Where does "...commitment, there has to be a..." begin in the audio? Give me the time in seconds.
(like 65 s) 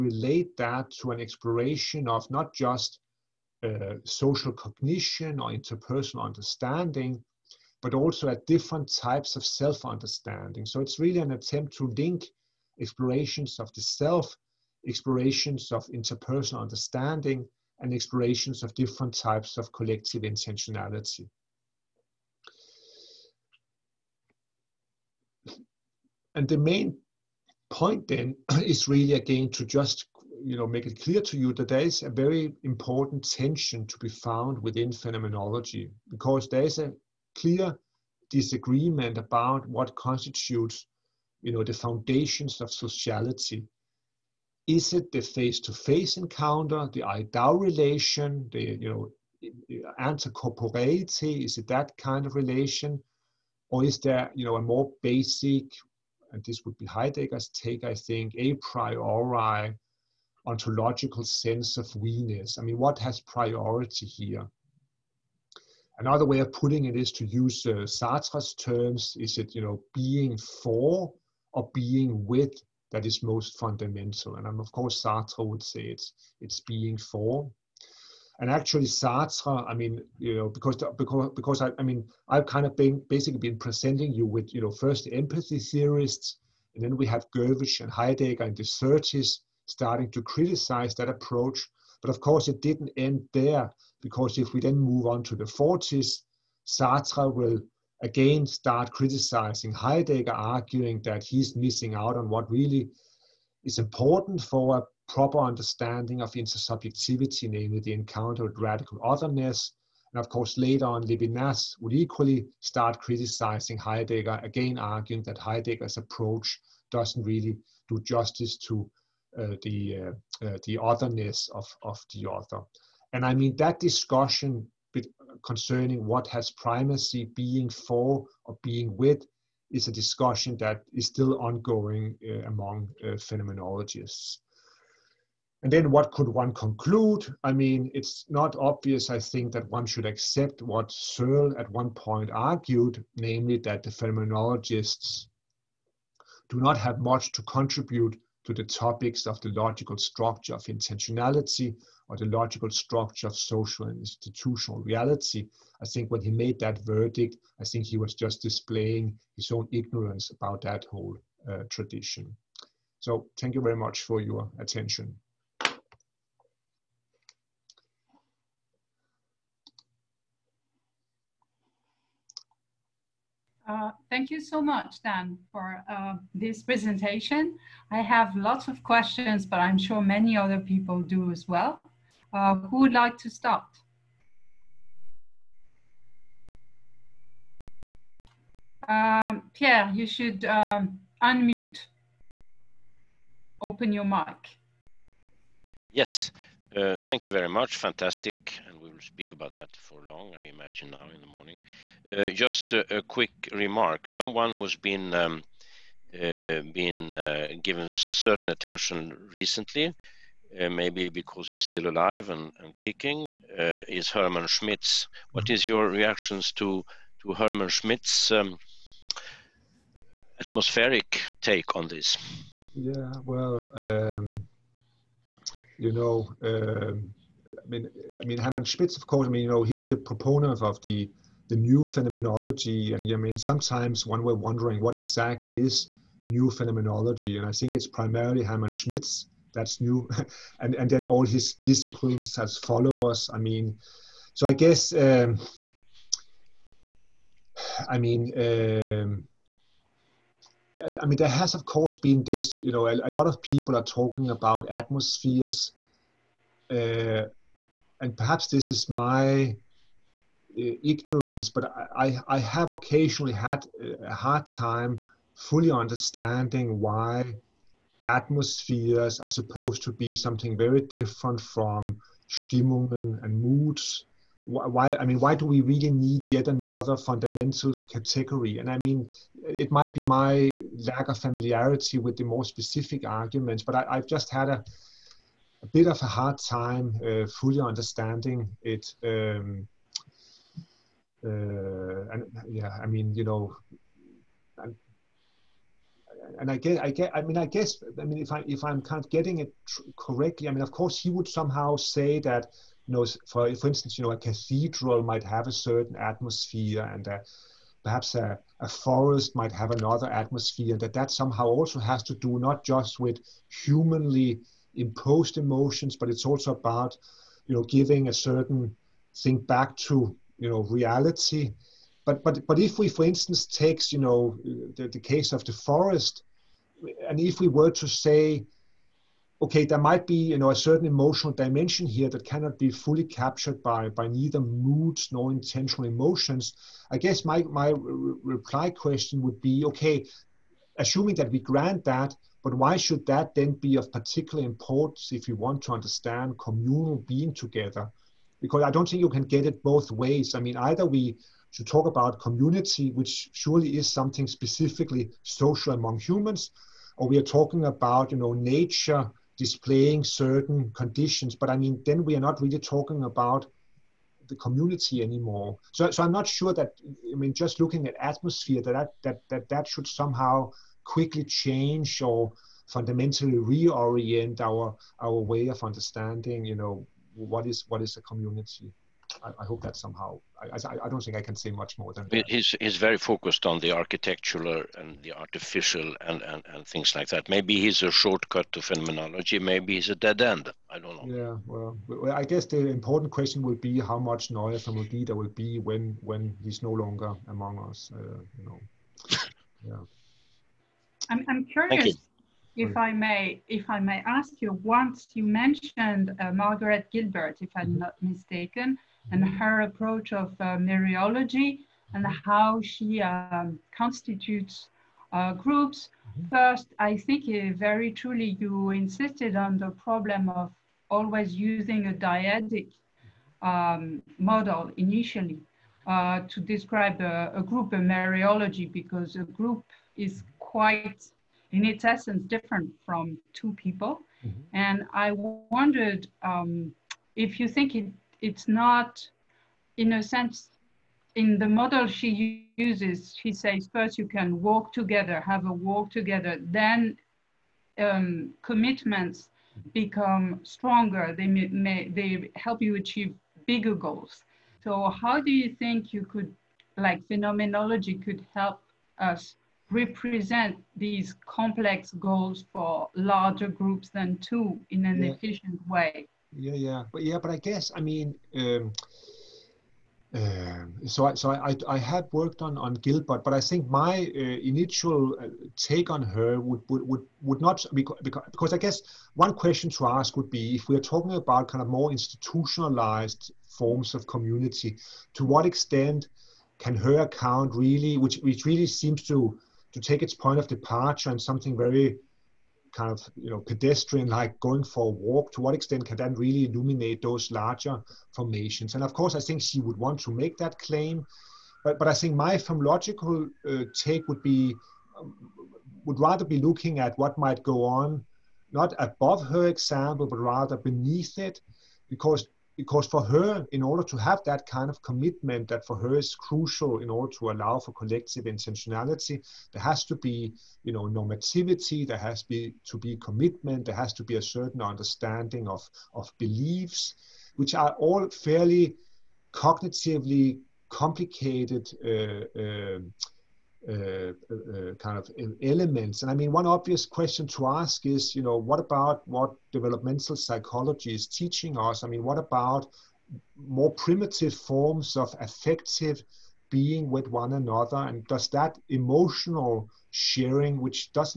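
522 s.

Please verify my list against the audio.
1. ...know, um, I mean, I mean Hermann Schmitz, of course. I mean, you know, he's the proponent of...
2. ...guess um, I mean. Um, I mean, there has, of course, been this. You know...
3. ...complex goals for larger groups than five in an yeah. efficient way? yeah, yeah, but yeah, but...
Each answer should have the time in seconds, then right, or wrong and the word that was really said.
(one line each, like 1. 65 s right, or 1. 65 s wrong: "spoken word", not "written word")
1. 225 s right
2. 244 s right
3. 461 s wrong: "two", not "five".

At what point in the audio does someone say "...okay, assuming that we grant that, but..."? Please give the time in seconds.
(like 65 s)
339 s.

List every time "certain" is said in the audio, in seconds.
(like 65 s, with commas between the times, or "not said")
207 s, 305 s, 318 s, 330 s, 360 s, 524 s.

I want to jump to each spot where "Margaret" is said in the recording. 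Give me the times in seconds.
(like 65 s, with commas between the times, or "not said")
406 s.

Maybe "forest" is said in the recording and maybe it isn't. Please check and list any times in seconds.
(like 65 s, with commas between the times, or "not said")
308 s, 325 s.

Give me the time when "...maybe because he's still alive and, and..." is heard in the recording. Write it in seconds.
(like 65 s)
210 s.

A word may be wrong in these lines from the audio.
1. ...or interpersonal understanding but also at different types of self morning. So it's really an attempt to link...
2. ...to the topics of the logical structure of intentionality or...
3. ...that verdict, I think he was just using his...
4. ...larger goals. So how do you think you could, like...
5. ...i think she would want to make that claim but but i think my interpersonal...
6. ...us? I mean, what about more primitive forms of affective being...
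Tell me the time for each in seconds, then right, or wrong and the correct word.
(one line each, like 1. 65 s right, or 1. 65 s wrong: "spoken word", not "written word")
1. 5 s wrong: "understanding", not "morning"
2. 148 s right
3. 156 s wrong: "displaying", not "using"
4. 453 s wrong: "bigger", not "larger"
5. 499 s wrong: "phenomenological", not "interpersonal"
6. 541 s right.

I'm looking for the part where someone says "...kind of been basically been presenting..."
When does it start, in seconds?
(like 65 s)
82 s.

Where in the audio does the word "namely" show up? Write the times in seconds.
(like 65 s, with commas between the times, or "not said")
107 s, 143 s.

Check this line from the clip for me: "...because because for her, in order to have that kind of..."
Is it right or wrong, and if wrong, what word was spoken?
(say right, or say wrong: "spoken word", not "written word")
right.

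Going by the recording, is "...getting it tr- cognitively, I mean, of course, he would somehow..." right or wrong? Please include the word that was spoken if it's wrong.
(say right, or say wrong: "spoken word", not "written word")
wrong: "correctly", not "cognitively".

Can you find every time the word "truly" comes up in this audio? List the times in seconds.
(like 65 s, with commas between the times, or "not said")
417 s.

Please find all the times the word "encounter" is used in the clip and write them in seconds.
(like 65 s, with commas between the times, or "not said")
46 s, 107 s.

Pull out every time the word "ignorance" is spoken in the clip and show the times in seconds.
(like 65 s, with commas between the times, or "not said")
159 s, 260 s.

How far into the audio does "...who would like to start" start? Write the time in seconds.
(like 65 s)
182 s.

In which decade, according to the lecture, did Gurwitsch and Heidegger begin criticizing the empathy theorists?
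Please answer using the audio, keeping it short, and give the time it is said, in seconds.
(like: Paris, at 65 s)
the 30s, at 88 s.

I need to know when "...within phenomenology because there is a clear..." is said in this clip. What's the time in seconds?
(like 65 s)
34 s.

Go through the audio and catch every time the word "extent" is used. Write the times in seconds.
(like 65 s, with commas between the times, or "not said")
485 s, 495 s.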